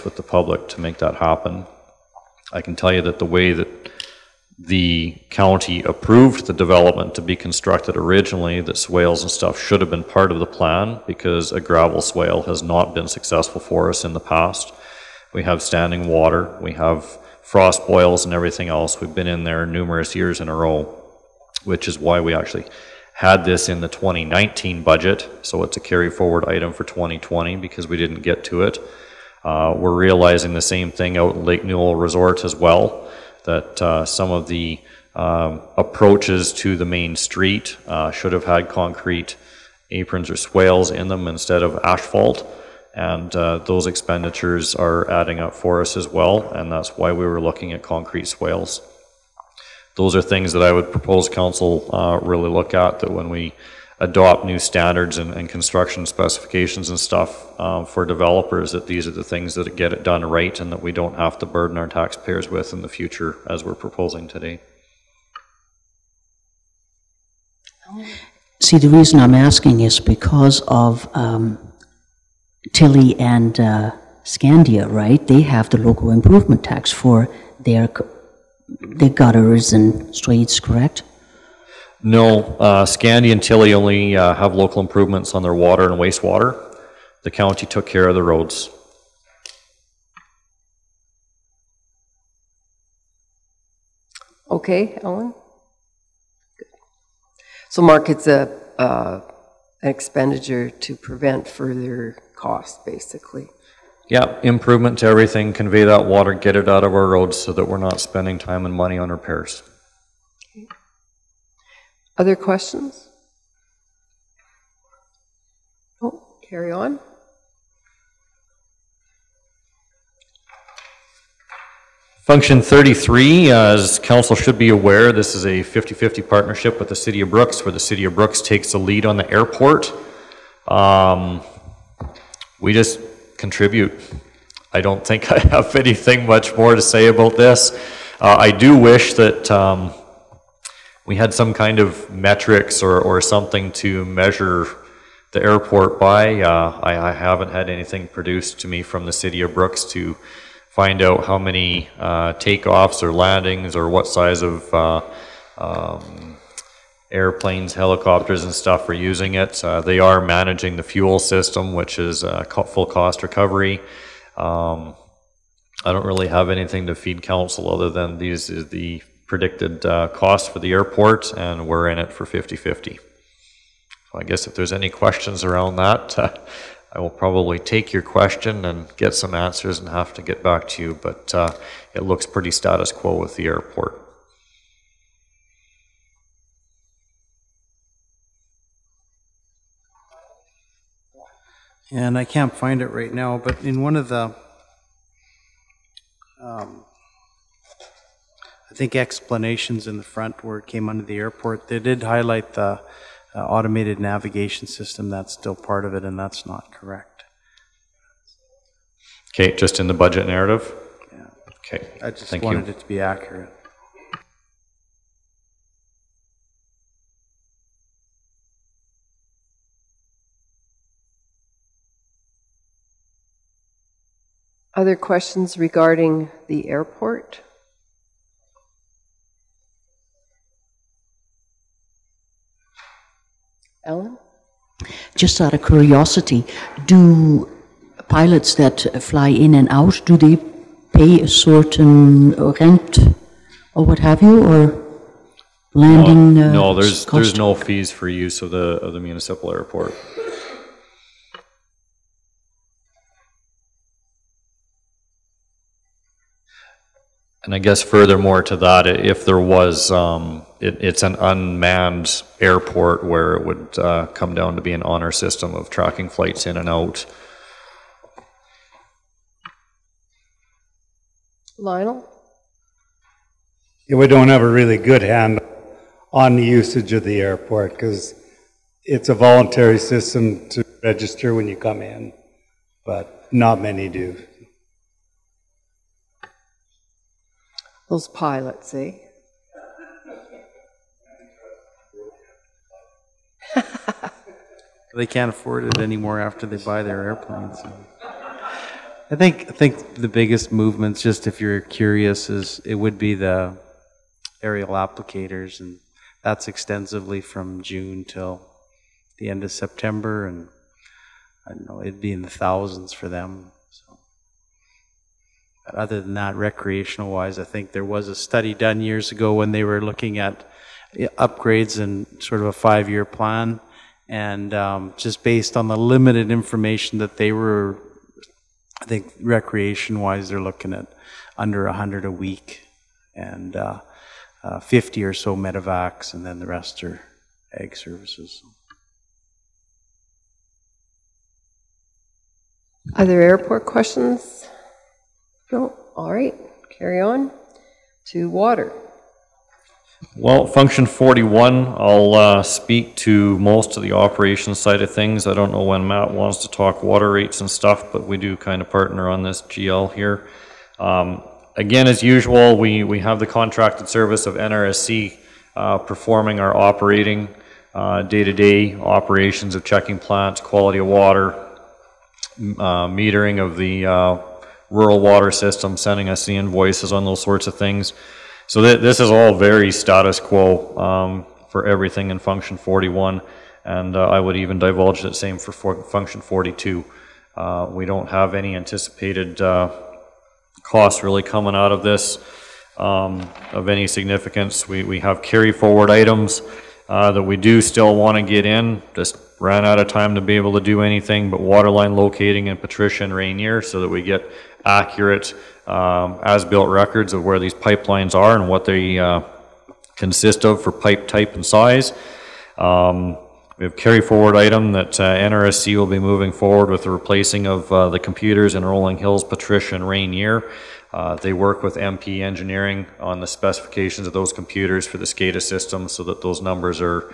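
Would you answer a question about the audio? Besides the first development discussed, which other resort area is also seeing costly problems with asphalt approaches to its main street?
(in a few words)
Lake Newell Resort.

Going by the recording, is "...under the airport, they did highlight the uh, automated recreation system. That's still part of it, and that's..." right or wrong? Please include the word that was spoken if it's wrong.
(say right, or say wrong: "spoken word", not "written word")
wrong: "navigation", not "recreation".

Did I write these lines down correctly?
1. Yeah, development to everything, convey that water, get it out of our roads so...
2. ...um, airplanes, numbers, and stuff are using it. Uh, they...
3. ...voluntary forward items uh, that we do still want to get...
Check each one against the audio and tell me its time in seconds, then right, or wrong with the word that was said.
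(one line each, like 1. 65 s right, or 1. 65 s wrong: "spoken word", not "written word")
1. 104 s wrong: "improvement", not "development"
2. 155 s wrong: "helicopters", not "numbers"
3. 395 s wrong: "carry", not "voluntary".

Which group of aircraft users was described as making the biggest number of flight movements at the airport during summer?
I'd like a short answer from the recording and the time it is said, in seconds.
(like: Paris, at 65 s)
aerial applicators, at 304 s.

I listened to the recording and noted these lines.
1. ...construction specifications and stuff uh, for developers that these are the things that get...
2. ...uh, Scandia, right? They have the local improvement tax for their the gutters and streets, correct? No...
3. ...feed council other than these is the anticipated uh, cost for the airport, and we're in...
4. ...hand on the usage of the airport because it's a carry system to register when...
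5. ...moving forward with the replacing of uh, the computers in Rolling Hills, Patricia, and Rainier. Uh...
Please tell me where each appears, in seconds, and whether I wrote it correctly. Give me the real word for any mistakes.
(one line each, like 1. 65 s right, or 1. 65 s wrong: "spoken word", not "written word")
1. 55 s right
2. 73 s right
3. 166 s wrong: "predicted", not "anticipated"
4. 275 s wrong: "voluntary", not "carry"
5. 415 s right.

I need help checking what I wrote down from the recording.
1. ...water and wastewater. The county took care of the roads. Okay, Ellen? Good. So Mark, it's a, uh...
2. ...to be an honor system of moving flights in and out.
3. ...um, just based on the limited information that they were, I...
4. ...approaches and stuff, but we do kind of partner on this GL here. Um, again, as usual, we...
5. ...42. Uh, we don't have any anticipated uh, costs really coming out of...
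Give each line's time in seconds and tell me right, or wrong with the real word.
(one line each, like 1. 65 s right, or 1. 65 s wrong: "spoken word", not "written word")
1. 85 s right
2. 264 s wrong: "tracking", not "moving"
3. 324 s right
4. 357 s wrong: "rates", not "approaches"
5. 386 s right.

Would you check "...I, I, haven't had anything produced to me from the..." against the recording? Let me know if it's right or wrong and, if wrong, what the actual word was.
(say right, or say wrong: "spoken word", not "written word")
right.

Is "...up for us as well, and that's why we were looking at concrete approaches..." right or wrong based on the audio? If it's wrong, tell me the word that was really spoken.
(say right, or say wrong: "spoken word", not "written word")
wrong: "swales", not "approaches".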